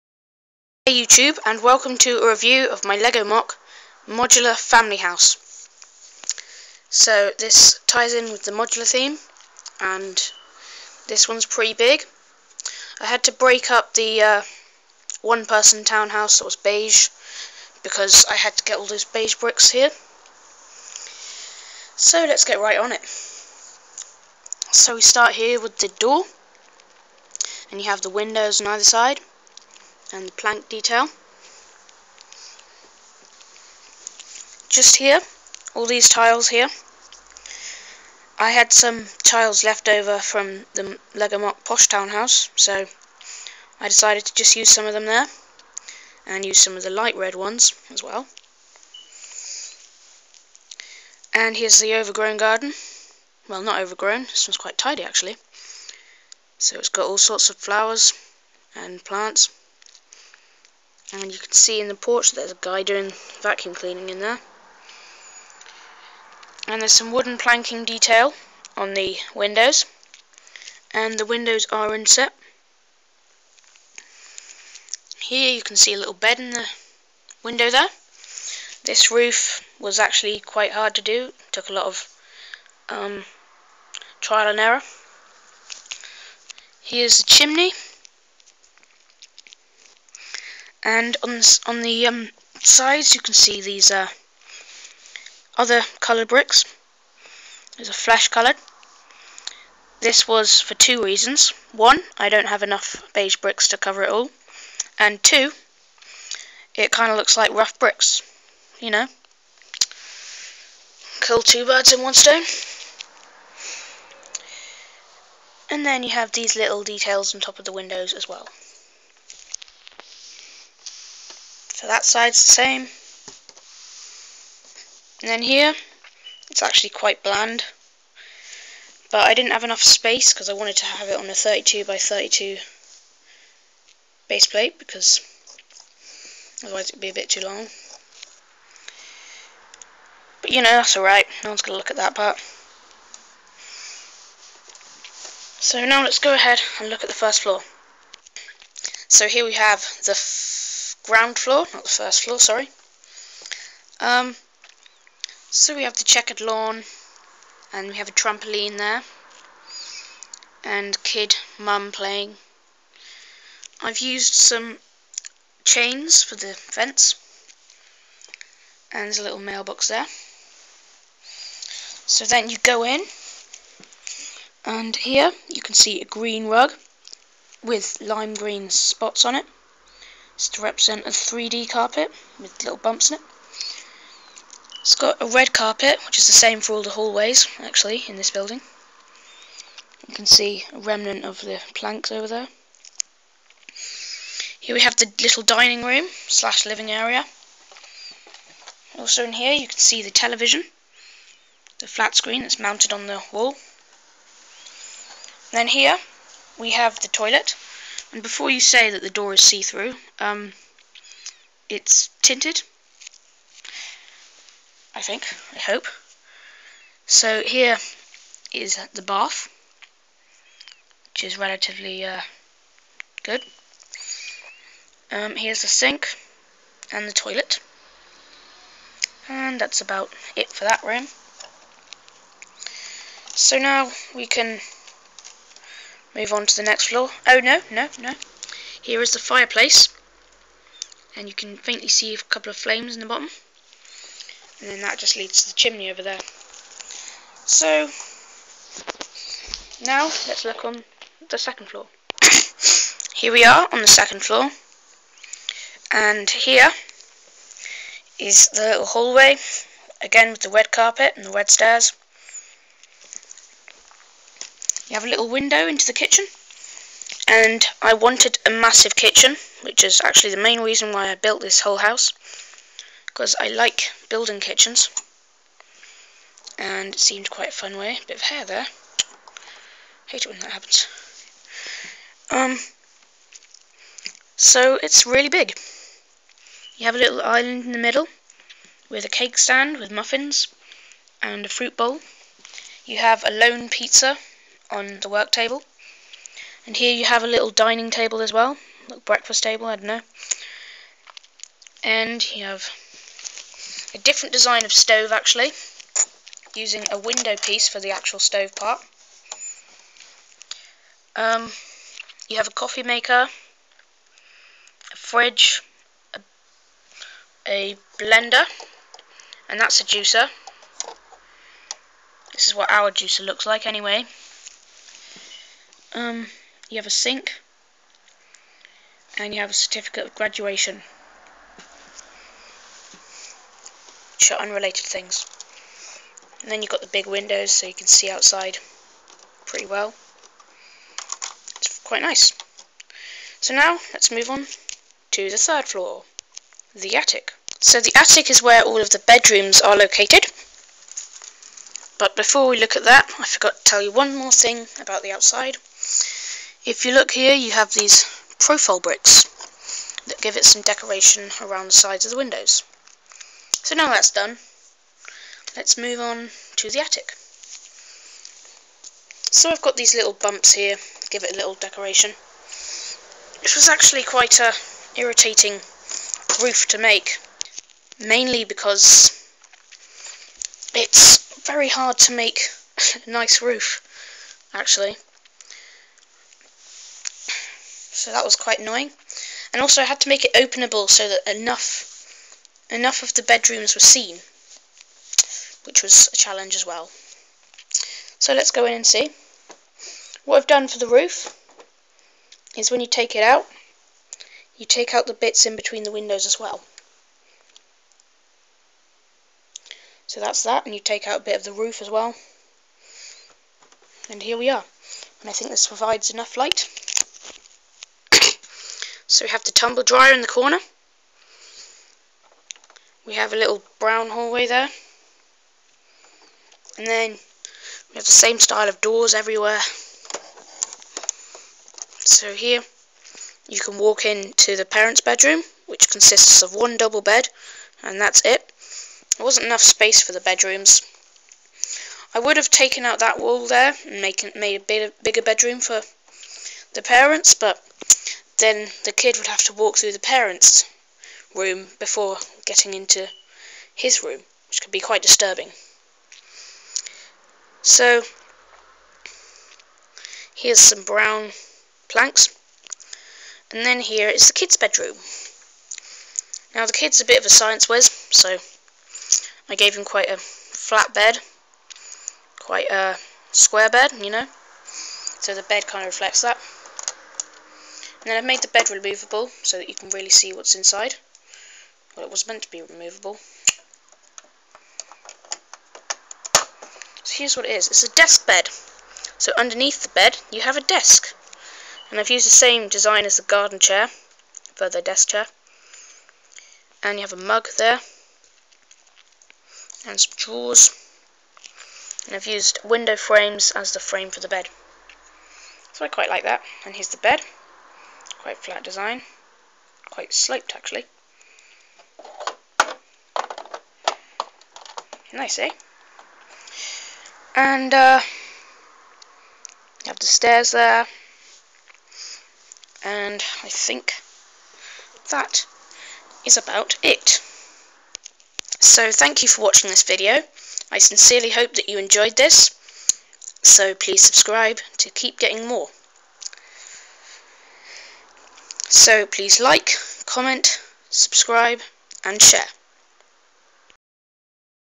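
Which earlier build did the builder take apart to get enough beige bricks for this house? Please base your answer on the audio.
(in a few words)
one person townhouse.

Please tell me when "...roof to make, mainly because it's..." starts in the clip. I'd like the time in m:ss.
6:16.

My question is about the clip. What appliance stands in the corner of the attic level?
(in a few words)
tumble dryer.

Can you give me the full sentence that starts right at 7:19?
There wasn't enough space for the bedrooms.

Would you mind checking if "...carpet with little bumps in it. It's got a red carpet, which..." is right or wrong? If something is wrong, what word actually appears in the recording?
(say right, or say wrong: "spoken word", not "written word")
right.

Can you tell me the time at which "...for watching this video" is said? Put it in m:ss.
8:49.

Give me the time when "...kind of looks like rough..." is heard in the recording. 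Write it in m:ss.
1:46.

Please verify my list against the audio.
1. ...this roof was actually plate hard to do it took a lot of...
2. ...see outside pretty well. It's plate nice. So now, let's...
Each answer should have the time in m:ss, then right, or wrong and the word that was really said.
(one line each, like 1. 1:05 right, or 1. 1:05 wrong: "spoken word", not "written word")
1. 1:18 wrong: "quite", not "plate"
2. 5:37 wrong: "quite", not "plate".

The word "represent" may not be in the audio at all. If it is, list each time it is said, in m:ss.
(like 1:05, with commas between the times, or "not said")
3:00.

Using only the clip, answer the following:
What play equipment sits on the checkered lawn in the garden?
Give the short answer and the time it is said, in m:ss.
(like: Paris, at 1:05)
trampoline, at 2:38.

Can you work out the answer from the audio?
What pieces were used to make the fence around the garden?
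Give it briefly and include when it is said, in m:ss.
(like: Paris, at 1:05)
chains, at 2:45.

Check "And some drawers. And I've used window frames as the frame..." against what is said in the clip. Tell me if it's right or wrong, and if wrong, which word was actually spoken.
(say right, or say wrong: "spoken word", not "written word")
right.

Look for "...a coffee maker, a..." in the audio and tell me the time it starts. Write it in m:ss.
5:12.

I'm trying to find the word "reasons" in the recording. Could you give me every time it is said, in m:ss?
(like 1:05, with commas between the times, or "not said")
1:41, 4:30.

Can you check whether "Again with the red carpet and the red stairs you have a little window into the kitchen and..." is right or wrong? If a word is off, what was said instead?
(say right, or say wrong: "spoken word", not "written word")
right.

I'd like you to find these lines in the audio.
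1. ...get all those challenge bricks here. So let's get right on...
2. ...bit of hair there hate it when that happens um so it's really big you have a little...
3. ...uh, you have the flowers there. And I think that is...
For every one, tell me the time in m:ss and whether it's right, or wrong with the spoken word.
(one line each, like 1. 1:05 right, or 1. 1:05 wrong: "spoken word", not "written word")
1. 0:18 wrong: "beige", not "challenge"
2. 4:38 right
3. 8:37 wrong: "stairs", not "flowers".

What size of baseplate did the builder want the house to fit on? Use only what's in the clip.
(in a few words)
32 by 32.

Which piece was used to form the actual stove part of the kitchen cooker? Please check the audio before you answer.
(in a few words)
window piece.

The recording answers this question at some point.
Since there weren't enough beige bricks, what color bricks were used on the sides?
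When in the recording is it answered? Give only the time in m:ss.
1:37.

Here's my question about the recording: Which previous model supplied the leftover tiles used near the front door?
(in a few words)
Lego MOC Posh Townhouse.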